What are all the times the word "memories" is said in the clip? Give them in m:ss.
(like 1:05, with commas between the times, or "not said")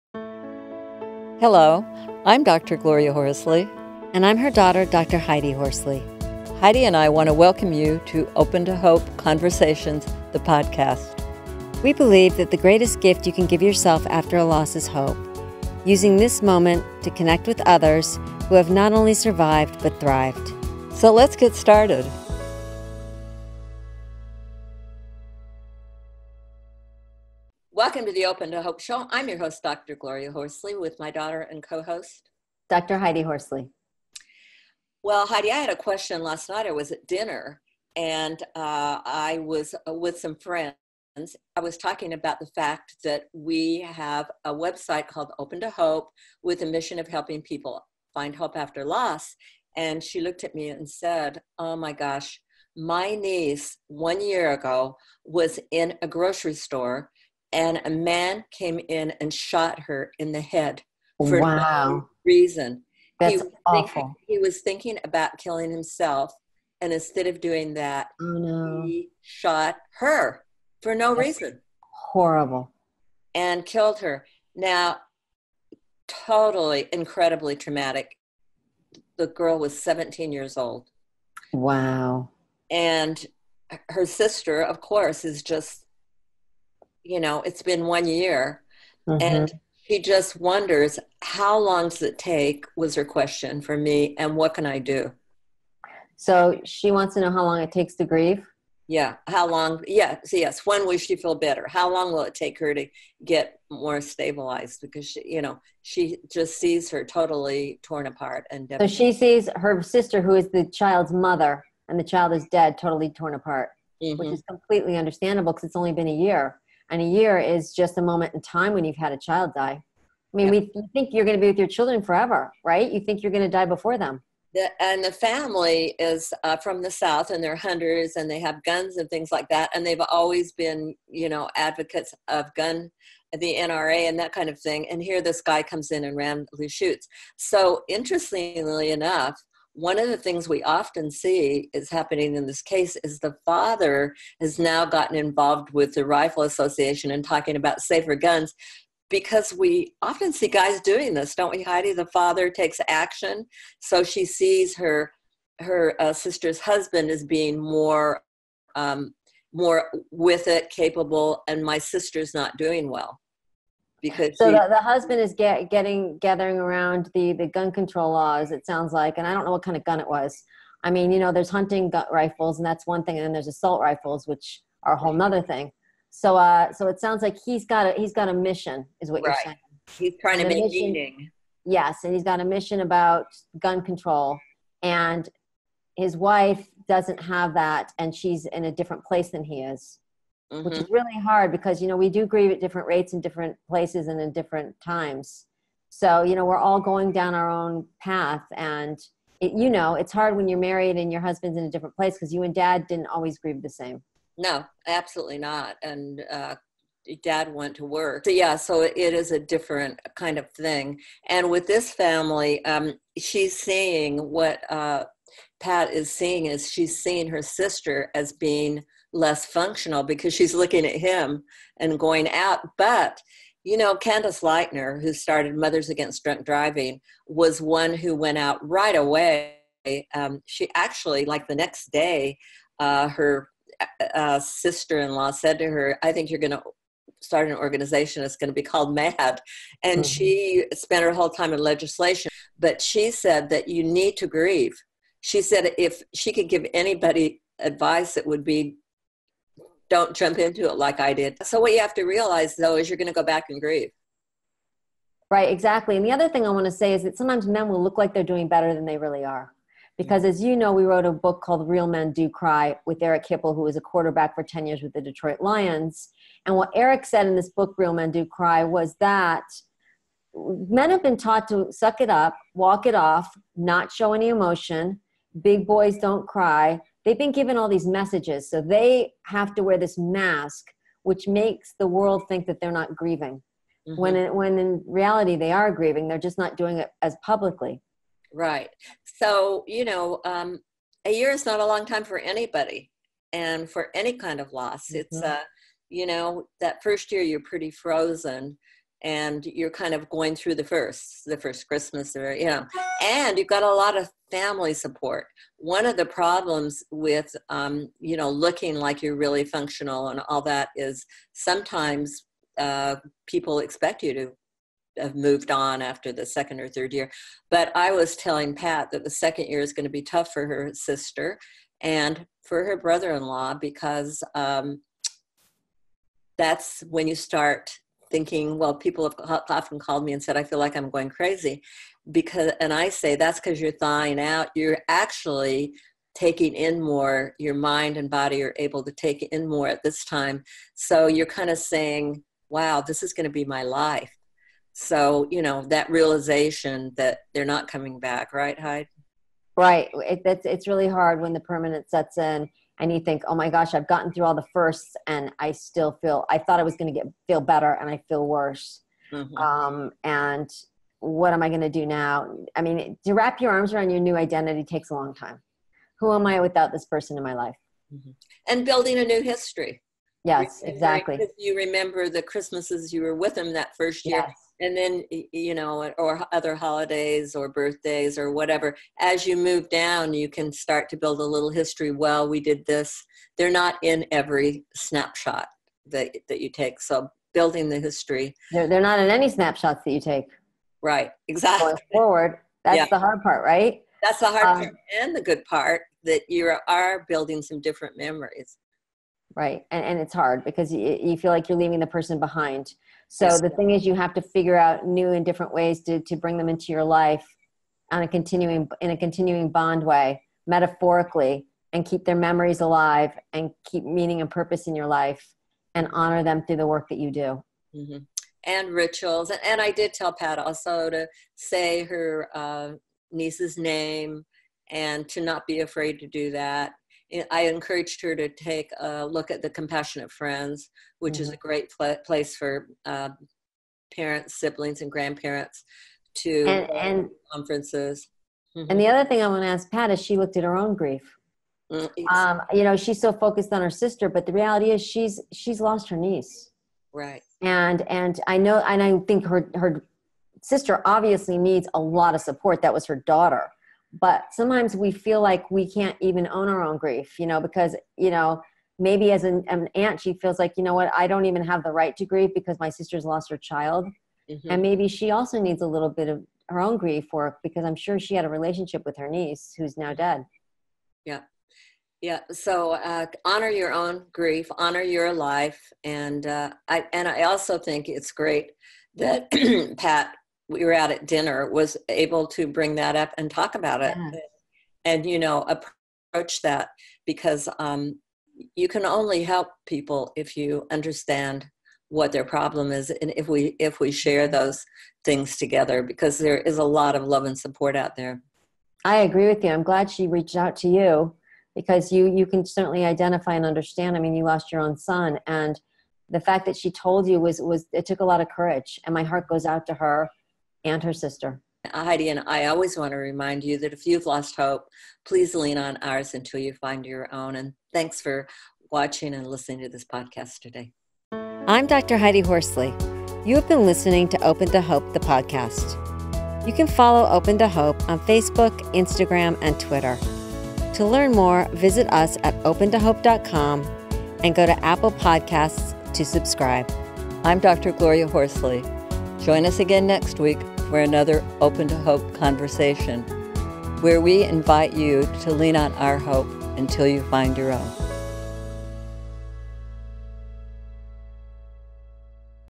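6:37, 6:52.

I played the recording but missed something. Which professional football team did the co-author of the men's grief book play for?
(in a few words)
Detroit Lions.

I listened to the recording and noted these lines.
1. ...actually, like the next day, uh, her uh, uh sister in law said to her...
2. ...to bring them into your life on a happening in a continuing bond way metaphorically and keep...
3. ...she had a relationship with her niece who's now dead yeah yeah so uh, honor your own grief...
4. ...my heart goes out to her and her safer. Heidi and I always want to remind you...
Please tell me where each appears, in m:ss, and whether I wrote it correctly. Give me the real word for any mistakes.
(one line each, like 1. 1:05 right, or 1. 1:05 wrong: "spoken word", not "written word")
1. 3:50 right
2. 6:46 wrong: "continuing", not "happening"
3. 7:47 right
4. 8:28 wrong: "sister", not "safer".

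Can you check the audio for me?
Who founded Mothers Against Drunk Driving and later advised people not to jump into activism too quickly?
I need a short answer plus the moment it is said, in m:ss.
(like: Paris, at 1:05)
Candace Lightner, at 3:43.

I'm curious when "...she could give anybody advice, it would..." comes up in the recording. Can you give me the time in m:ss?
4:06.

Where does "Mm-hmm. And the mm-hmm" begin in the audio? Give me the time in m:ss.
7:18.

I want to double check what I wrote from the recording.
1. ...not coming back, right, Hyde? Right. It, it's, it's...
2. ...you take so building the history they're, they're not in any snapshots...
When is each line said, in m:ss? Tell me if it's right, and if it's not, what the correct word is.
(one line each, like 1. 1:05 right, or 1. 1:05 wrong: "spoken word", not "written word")
1. 5:47 right
2. 6:26 right.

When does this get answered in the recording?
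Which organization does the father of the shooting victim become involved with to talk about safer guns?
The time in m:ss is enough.
2:26.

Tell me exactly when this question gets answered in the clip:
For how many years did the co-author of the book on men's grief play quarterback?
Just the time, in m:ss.
4:24.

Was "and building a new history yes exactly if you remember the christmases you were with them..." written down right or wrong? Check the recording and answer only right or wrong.
right.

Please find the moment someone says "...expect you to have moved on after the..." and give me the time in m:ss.
5:13.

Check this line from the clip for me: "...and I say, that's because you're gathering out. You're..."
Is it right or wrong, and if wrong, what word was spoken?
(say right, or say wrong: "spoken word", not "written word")
wrong: "thawing", not "gathering".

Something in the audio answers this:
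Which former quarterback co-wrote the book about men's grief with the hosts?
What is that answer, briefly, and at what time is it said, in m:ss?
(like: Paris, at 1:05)
Eric Hipple, at 4:23.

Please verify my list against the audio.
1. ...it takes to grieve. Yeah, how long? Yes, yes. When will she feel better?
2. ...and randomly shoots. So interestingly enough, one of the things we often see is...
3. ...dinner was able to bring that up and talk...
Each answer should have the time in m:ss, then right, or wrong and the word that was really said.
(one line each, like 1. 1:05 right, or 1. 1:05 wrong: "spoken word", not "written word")
1. 1:37 right
2. 2:16 right
3. 8:01 right.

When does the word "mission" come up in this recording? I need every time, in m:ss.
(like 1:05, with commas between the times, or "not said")
0:46, 2:58, 3:02.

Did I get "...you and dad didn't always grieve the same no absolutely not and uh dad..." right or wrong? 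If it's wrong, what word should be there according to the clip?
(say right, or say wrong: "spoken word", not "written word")
right.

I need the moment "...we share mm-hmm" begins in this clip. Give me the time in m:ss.
8:13.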